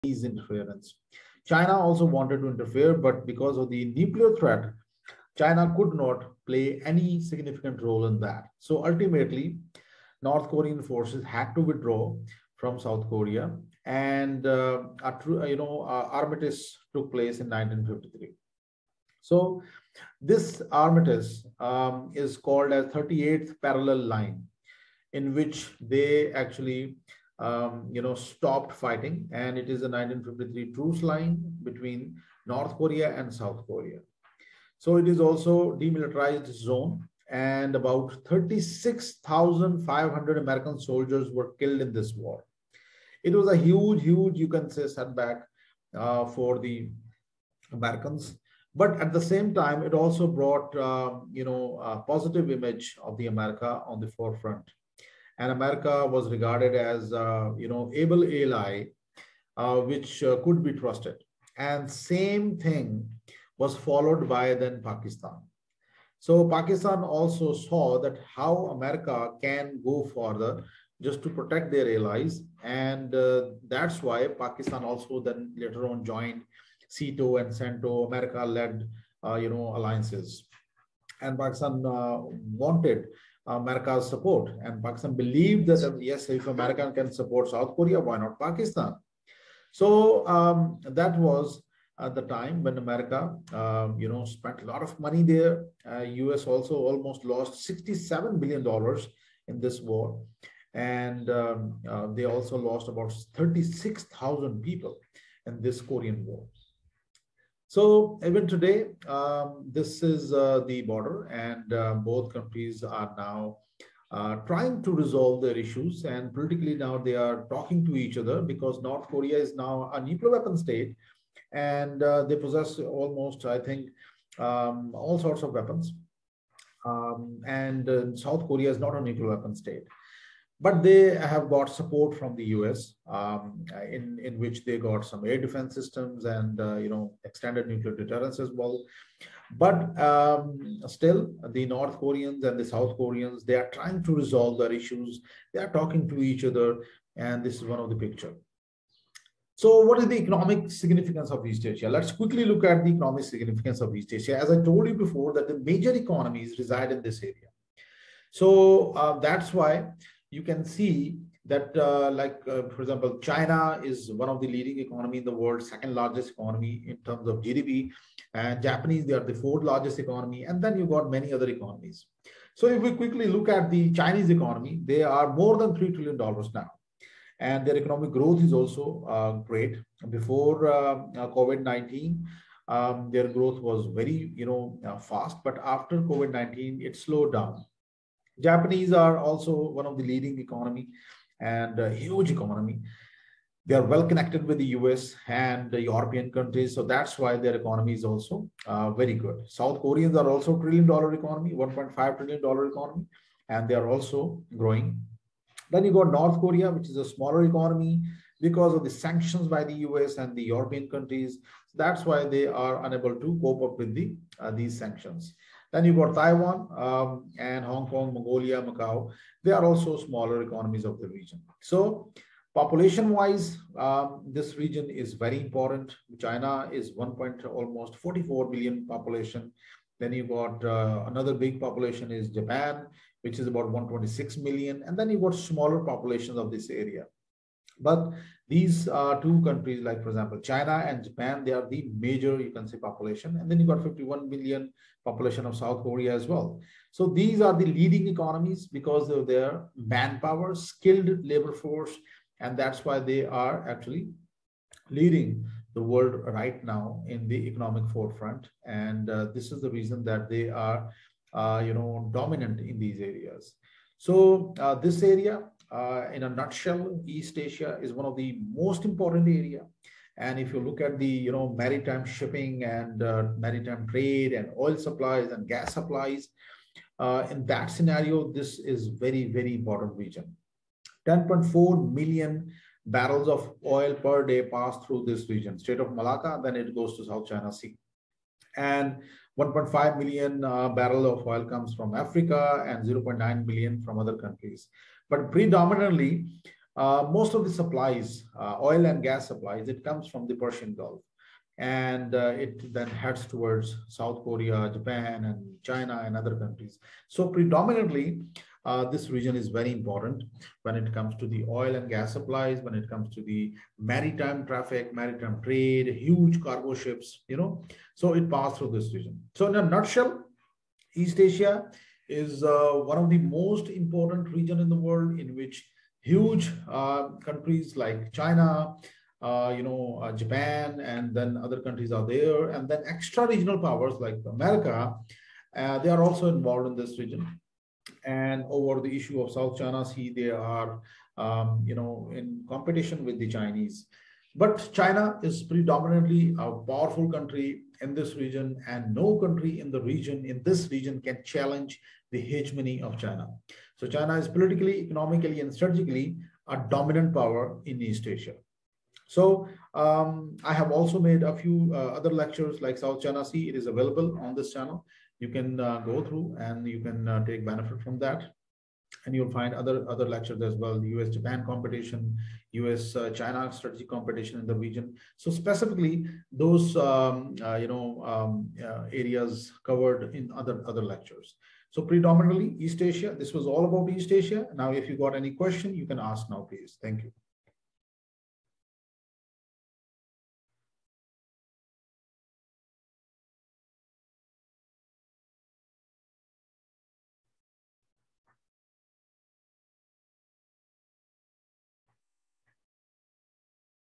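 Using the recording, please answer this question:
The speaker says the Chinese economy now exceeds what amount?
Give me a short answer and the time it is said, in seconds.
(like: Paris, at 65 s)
3 trillion dollars, at 175 s.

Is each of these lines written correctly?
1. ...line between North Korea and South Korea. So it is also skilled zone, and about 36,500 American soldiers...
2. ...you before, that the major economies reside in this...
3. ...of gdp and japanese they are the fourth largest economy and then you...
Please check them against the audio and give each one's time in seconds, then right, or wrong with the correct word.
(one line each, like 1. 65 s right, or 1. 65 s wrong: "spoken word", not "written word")
1. 31 s wrong: "demilitarized", not "skilled"
2. 154 s right
3. 167 s right.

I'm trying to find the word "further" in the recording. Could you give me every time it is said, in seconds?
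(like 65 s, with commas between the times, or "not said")
70 s.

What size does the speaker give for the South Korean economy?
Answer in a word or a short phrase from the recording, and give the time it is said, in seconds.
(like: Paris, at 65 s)
$1.5 trillion, at 201 s.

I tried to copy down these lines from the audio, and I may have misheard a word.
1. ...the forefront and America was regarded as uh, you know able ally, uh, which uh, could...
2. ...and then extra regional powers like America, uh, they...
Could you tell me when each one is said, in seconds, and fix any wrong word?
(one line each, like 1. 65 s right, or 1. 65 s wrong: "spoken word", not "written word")
1. 53 s right
2. 332 s right.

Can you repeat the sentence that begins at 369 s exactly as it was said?
And you'll find other, other lectures as well, US-Japan competition, US-China uh, strategic competition in the region.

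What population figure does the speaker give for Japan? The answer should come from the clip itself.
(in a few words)
126 million.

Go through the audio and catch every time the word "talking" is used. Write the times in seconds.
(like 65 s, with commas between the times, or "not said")
117 s, 145 s.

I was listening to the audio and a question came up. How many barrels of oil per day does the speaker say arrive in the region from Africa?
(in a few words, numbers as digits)
1.5 million.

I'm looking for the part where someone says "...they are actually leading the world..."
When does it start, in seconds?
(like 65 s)
253 s.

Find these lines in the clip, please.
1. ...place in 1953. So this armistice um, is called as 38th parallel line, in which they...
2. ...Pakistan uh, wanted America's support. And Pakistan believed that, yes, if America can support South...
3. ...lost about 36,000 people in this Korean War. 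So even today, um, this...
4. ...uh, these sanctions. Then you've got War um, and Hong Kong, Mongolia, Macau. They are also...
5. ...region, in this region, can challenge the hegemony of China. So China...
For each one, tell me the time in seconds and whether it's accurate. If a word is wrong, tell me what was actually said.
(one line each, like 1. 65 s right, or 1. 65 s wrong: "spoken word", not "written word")
1. 17 s right
2. 81 s right
3. 102 s right
4. 214 s wrong: "Taiwan", not "War"
5. 349 s right.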